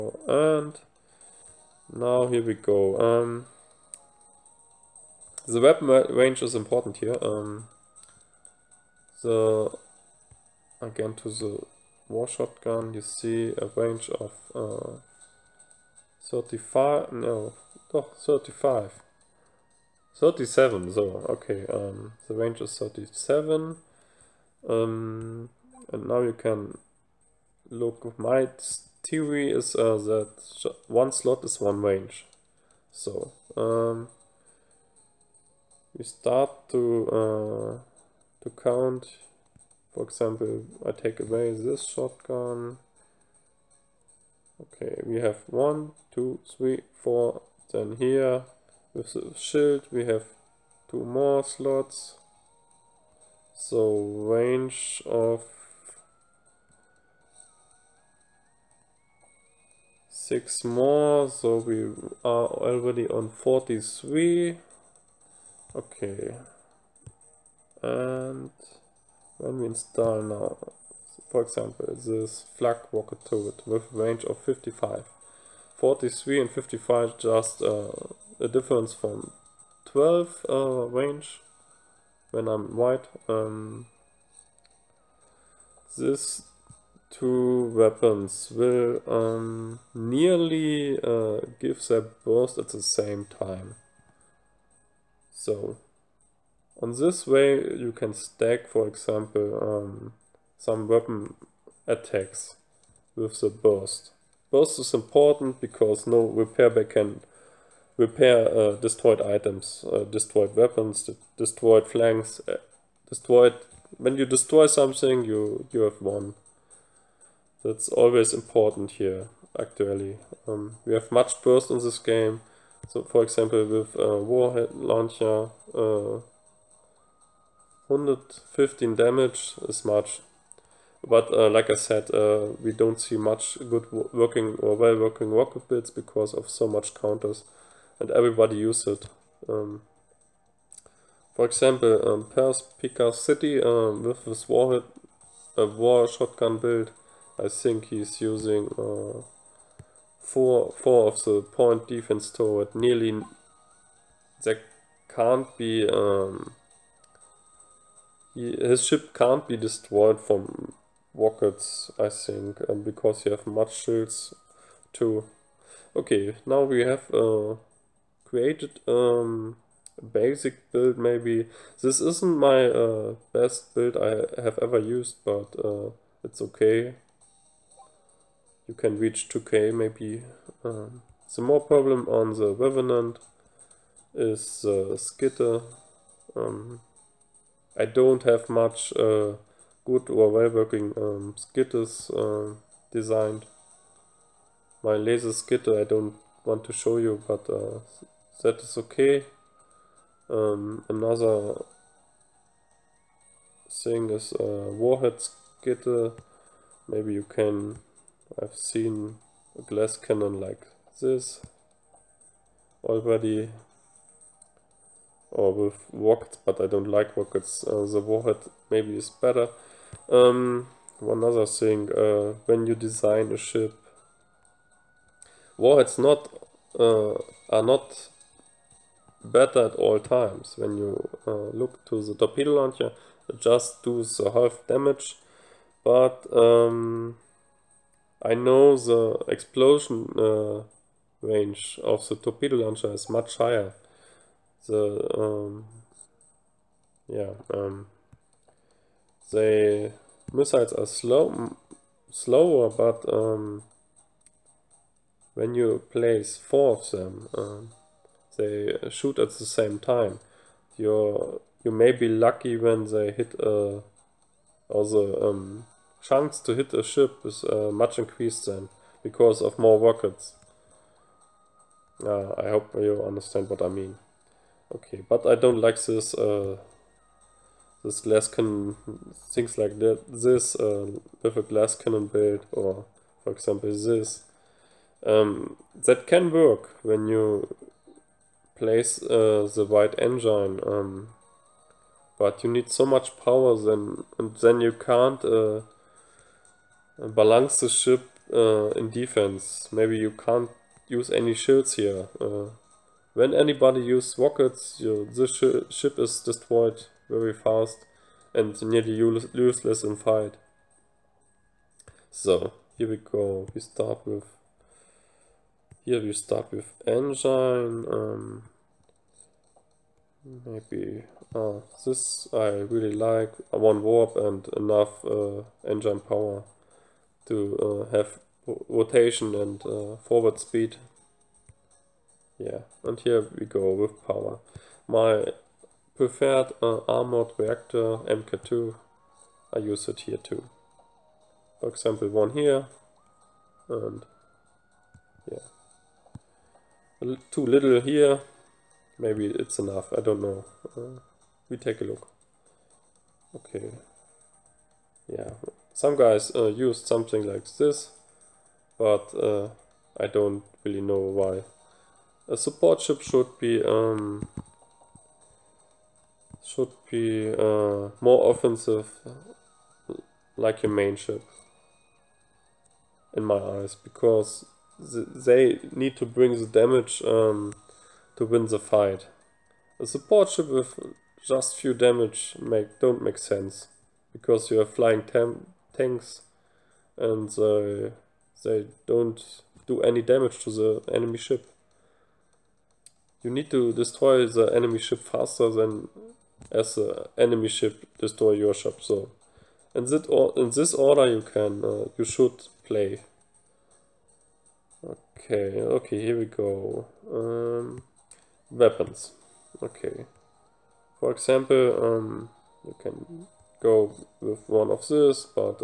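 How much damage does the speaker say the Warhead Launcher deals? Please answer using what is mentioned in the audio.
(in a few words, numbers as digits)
115.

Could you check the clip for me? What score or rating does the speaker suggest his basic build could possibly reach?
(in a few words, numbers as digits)
2k.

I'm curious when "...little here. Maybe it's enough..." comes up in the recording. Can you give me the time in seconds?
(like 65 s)
347 s.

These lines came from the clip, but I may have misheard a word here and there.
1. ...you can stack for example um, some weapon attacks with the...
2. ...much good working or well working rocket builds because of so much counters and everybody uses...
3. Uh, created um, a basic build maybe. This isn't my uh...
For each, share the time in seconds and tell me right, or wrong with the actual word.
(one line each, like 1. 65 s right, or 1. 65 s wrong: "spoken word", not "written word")
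1. 97 s right
2. 133 s right
3. 167 s right.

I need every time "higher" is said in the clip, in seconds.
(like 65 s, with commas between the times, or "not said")
243 s.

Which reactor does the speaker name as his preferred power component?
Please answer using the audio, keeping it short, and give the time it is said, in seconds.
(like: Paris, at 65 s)
armored reactor MK2, at 336 s.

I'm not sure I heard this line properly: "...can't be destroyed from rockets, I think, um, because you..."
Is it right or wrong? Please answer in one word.
right.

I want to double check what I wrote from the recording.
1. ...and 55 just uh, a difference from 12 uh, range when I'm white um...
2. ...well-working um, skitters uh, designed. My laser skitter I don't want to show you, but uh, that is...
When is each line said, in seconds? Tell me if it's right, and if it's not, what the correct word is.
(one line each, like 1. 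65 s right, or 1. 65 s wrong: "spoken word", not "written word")
1. 76 s right
2. 190 s right.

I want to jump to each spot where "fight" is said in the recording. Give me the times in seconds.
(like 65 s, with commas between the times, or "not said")
309 s, 378 s.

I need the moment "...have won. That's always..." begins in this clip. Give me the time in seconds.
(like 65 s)
115 s.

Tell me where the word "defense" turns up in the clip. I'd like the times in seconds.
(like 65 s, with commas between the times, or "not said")
151 s, 298 s.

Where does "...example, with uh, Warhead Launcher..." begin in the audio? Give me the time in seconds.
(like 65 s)
123 s.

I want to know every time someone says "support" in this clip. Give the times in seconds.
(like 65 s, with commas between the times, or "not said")
362 s, 379 s.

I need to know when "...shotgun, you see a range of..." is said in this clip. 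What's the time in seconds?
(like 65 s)
12 s.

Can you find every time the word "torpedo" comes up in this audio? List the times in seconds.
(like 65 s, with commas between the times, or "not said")
232 s, 242 s.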